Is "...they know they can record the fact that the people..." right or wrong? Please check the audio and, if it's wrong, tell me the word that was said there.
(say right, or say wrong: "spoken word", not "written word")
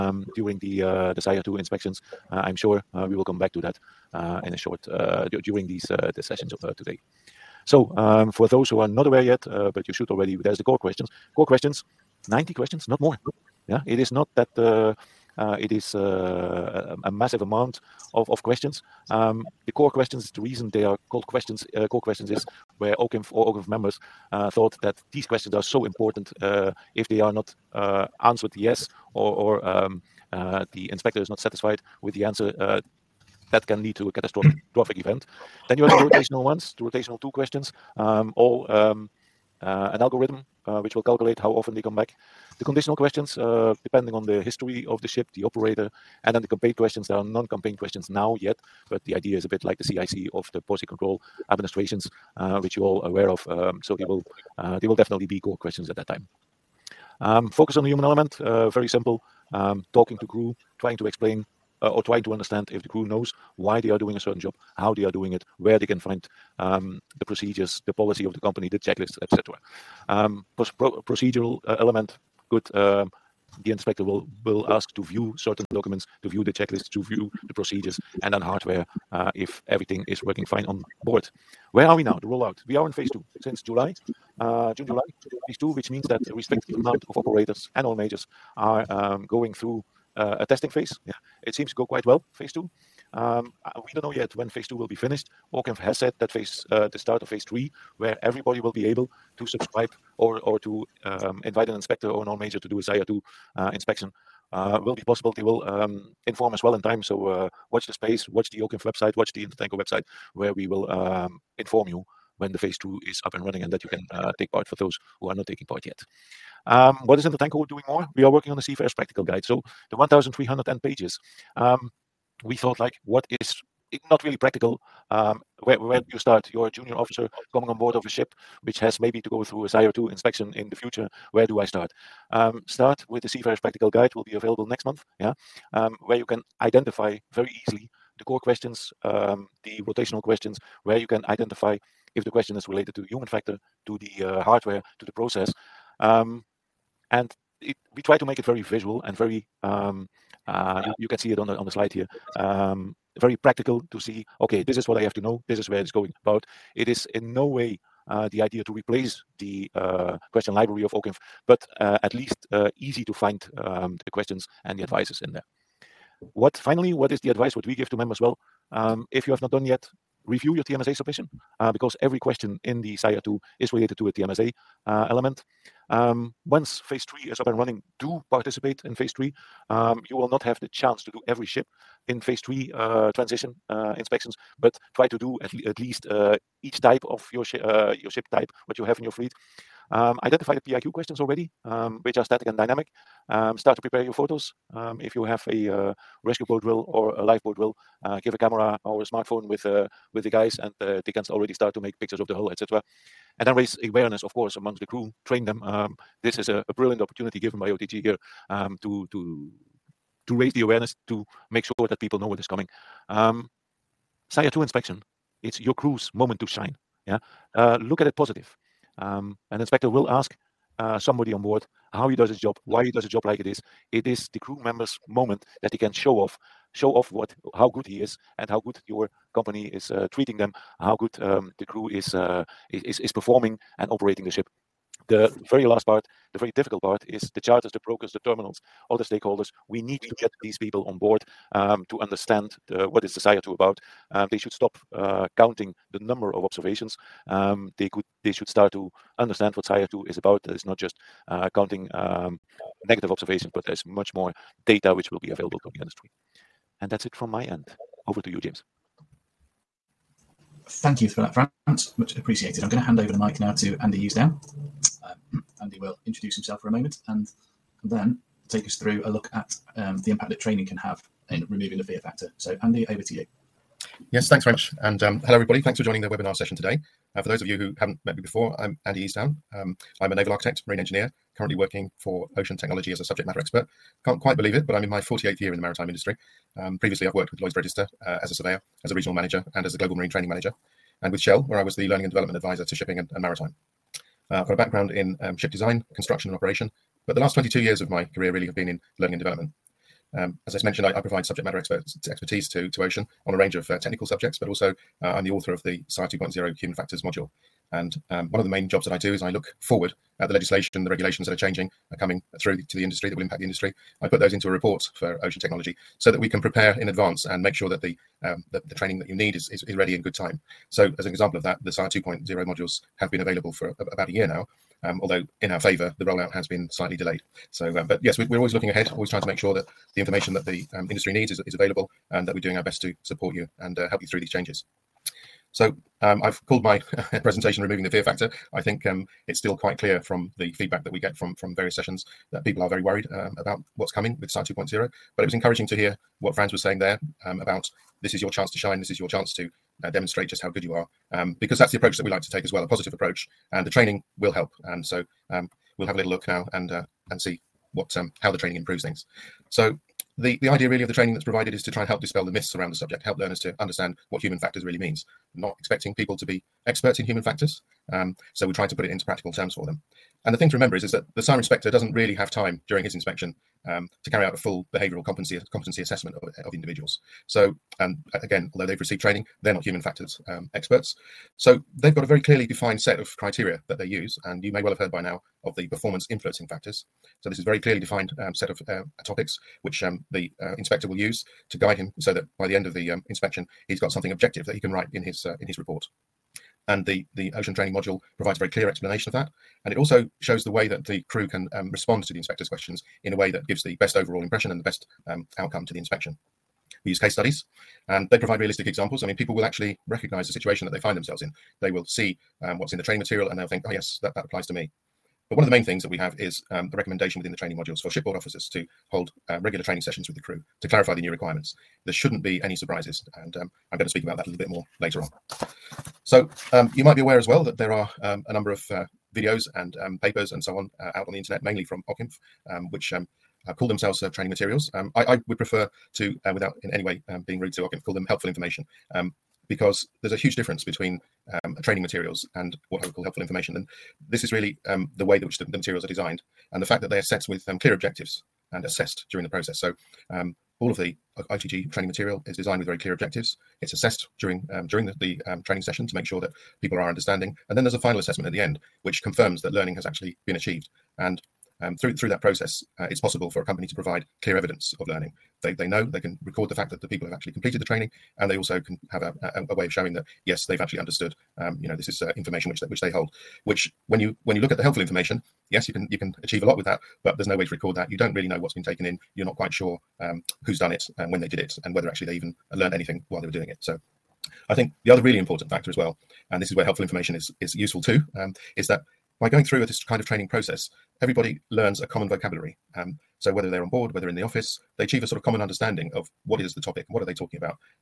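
right.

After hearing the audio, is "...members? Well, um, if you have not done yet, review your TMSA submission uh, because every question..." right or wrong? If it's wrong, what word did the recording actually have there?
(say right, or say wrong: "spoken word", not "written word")
right.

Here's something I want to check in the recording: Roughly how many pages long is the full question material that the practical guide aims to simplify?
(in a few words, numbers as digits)
1,300.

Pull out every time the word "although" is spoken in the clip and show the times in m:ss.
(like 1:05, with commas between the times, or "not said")
5:25, 6:18.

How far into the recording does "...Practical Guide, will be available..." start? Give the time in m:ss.
2:13.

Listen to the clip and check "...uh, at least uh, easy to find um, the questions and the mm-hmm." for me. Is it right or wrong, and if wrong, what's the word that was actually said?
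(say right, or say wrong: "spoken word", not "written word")
right.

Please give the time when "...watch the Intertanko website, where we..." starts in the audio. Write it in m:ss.
1:49.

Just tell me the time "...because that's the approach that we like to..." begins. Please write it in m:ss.
5:51.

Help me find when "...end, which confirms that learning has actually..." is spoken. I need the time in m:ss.
7:38.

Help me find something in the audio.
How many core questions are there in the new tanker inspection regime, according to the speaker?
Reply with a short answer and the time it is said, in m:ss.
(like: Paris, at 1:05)
90, at 0:12.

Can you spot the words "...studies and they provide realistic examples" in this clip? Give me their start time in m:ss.
6:47.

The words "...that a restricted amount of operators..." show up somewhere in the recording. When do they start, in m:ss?
1:26.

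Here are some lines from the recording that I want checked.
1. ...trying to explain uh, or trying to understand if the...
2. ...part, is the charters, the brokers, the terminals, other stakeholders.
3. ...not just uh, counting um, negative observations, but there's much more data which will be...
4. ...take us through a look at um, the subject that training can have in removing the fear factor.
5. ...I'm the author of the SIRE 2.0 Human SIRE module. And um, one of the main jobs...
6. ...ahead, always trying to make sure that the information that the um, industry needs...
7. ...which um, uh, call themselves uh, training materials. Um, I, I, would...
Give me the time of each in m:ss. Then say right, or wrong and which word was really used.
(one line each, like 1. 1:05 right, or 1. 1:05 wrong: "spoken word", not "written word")
1. 1:00 right
2. 3:56 right
3. 4:10 right
4. 4:28 wrong: "impact", not "subject"
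5. 5:05 wrong: "Factors", not "SIRE"
6. 5:28 right
7. 7:12 right.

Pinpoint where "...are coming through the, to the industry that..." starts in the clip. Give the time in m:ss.
5:11.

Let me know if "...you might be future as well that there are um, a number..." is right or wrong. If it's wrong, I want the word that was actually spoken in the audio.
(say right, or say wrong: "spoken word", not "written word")
wrong: "aware", not "future".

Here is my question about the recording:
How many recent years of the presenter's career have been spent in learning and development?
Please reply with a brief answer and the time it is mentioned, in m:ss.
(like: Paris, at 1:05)
22, at 4:57.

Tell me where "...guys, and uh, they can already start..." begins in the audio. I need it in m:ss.
3:20.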